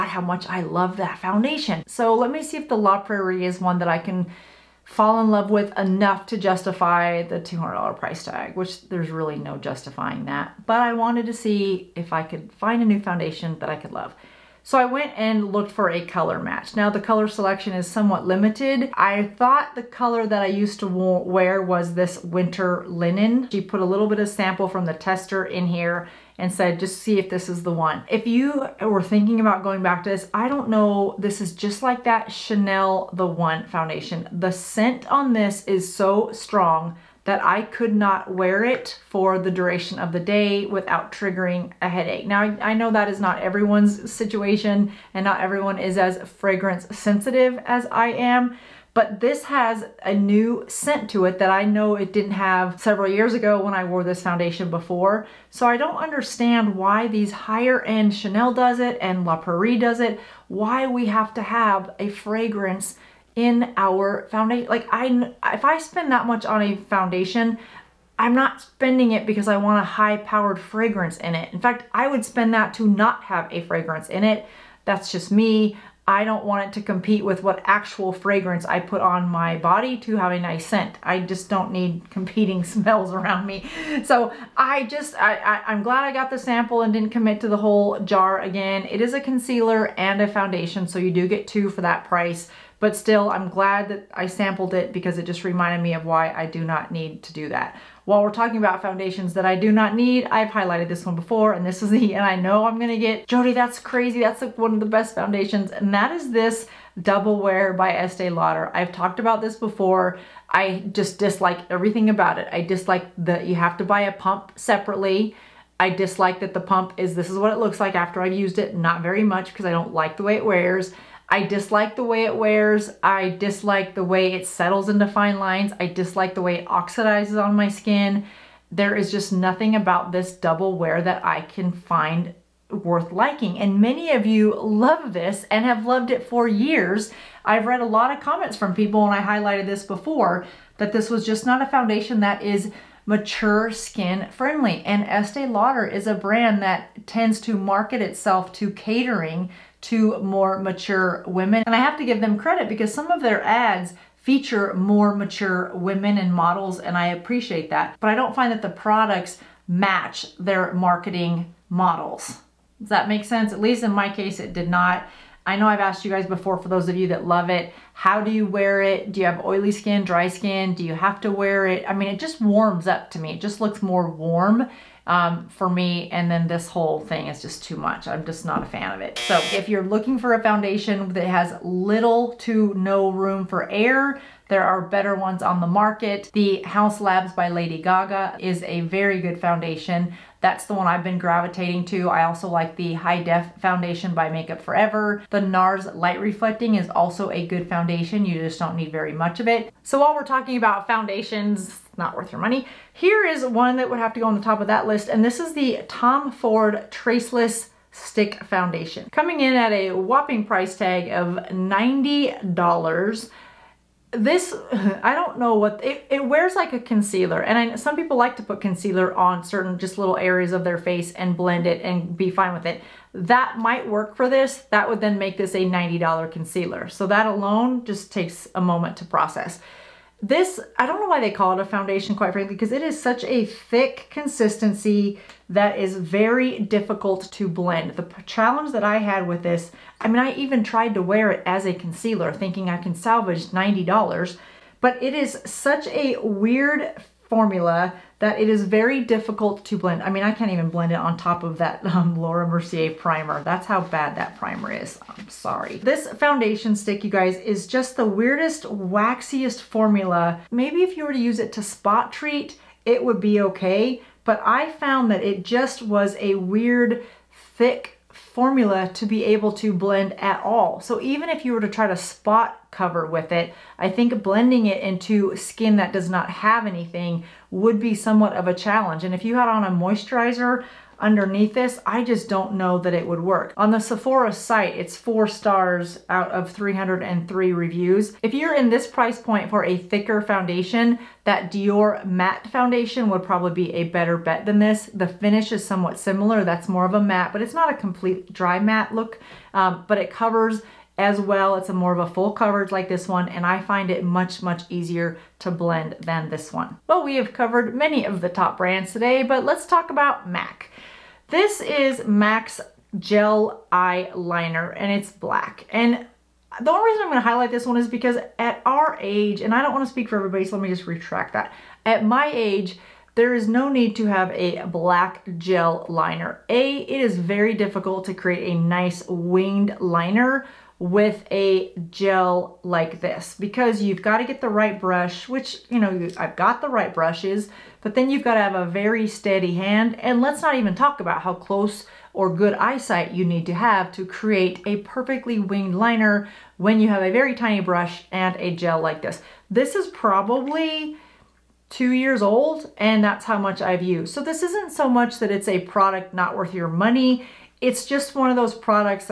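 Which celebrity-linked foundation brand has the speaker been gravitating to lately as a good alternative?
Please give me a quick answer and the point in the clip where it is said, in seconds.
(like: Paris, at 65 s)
Haus Labs, at 186 s.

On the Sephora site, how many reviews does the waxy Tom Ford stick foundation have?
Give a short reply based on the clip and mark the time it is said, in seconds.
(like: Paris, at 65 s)
303, at 286 s.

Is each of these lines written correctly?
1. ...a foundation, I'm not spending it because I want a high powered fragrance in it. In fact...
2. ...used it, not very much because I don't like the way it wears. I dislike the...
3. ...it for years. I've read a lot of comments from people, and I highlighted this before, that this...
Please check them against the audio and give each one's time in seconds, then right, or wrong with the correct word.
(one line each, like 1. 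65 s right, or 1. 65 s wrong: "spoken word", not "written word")
1. 66 s right
2. 118 s right
3. 136 s right.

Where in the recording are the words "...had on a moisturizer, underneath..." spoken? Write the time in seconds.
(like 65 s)
279 s.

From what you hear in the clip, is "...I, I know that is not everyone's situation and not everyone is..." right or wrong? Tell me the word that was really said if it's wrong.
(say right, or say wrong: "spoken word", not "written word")
right.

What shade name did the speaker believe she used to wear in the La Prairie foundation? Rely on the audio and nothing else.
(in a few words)
Winter Linen.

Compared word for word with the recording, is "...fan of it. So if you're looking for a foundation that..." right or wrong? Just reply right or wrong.
right.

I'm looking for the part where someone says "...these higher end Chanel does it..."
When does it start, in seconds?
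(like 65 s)
57 s.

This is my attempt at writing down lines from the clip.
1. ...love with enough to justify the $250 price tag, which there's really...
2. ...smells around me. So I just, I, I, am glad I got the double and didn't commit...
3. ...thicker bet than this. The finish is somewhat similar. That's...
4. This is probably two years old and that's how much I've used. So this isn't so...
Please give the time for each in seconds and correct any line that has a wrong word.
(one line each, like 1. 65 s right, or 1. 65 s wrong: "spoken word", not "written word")
1. 5 s wrong: "200", not "250"
2. 82 s wrong: "sample", not "double"
3. 293 s wrong: "better", not "thicker"
4. 349 s right.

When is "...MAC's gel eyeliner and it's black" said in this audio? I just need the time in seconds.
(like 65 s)
312 s.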